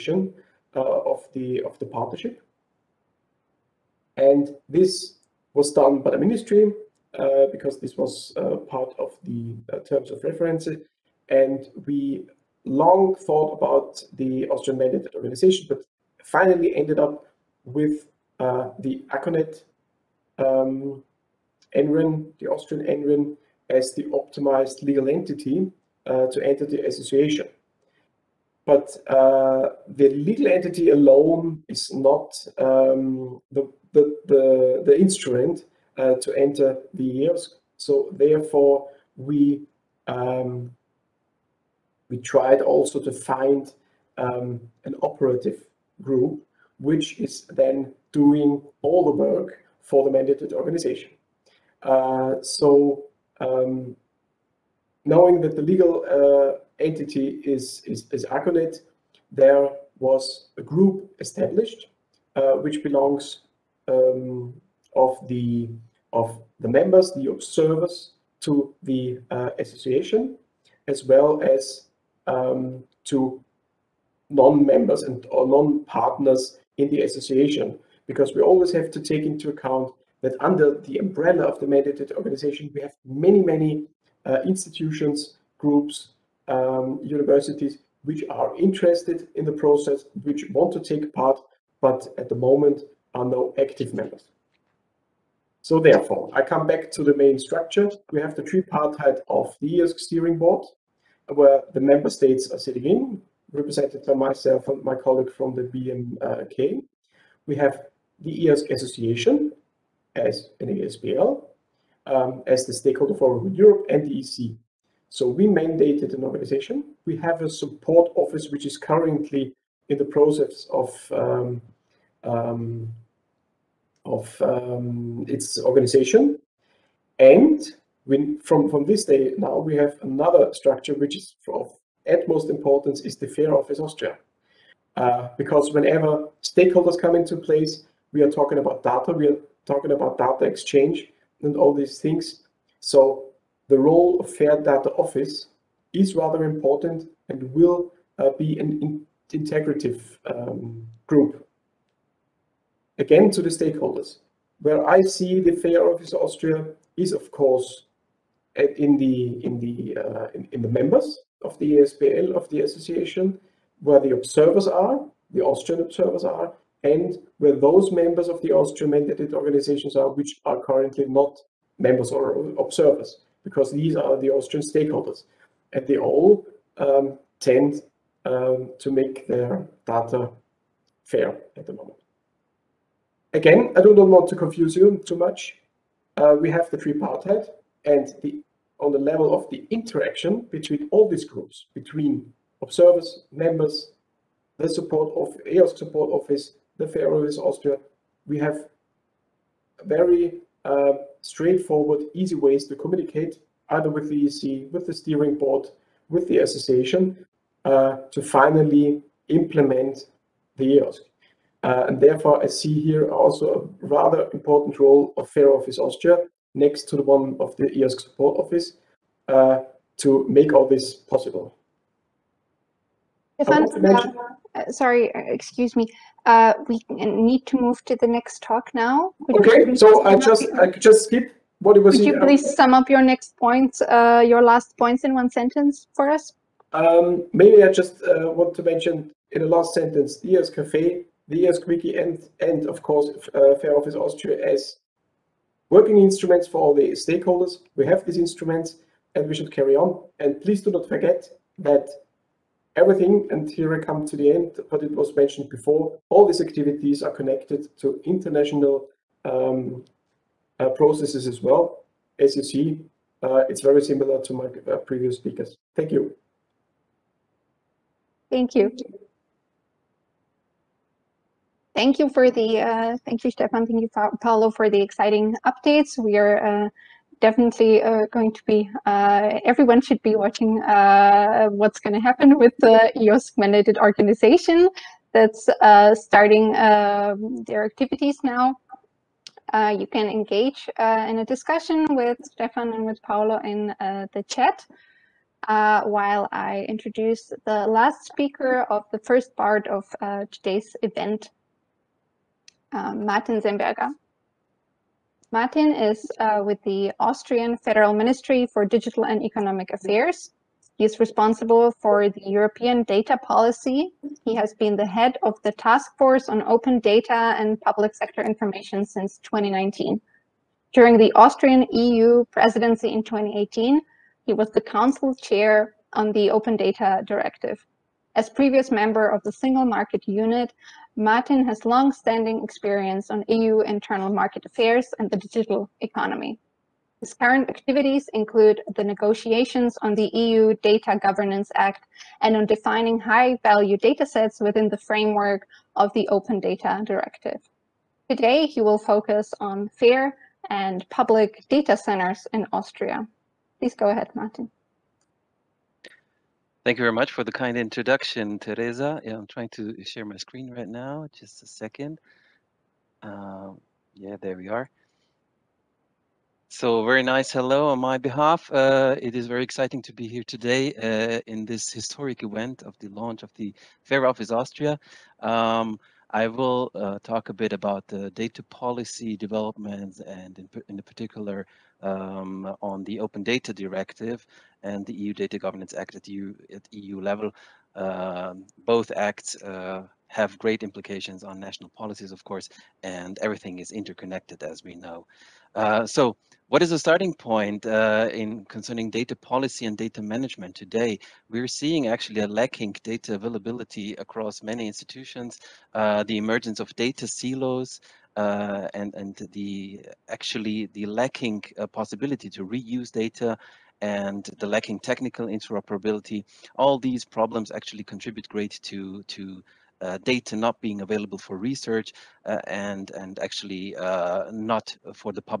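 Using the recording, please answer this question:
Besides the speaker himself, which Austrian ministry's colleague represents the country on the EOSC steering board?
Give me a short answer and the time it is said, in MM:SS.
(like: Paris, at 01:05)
BMK, at 01:45.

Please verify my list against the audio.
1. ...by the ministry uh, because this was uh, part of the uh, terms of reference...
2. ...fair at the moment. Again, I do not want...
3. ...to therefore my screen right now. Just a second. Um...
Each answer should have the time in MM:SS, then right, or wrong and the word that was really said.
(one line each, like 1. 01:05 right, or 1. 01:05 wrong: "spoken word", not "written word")
1. 00:06 right
2. 03:01 right
3. 05:59 wrong: "share", not "therefore".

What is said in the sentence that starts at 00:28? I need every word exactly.
But uh, the legal entity alone is not um, the, the, the, the, instrument uh, to enter the EOSC.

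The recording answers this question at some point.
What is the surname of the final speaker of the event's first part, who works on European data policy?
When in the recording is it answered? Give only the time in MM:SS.
05:03.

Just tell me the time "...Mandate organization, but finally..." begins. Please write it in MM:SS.
00:14.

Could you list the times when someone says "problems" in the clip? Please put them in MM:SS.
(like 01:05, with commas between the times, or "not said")
06:57.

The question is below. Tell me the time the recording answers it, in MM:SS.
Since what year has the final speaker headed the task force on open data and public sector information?
05:19.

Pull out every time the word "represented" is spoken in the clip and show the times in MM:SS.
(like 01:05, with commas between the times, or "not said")
01:43.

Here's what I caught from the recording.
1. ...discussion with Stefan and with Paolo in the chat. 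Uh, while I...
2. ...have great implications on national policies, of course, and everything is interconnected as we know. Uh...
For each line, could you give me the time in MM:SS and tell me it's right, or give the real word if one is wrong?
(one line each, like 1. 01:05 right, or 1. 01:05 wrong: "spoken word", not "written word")
1. 04:51 right
2. 06:30 right.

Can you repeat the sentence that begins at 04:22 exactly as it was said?
As you see, uh, it's very similar to my uh, previous speakers.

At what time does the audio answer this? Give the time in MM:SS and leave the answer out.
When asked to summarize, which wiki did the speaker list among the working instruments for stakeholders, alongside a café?
04:01.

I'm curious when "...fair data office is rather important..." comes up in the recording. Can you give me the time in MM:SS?
02:24.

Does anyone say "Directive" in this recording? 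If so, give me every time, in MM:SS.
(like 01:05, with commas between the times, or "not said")
05:27, 05:46, 06:23.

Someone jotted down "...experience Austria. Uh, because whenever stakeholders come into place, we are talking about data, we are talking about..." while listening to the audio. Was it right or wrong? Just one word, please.
wrong.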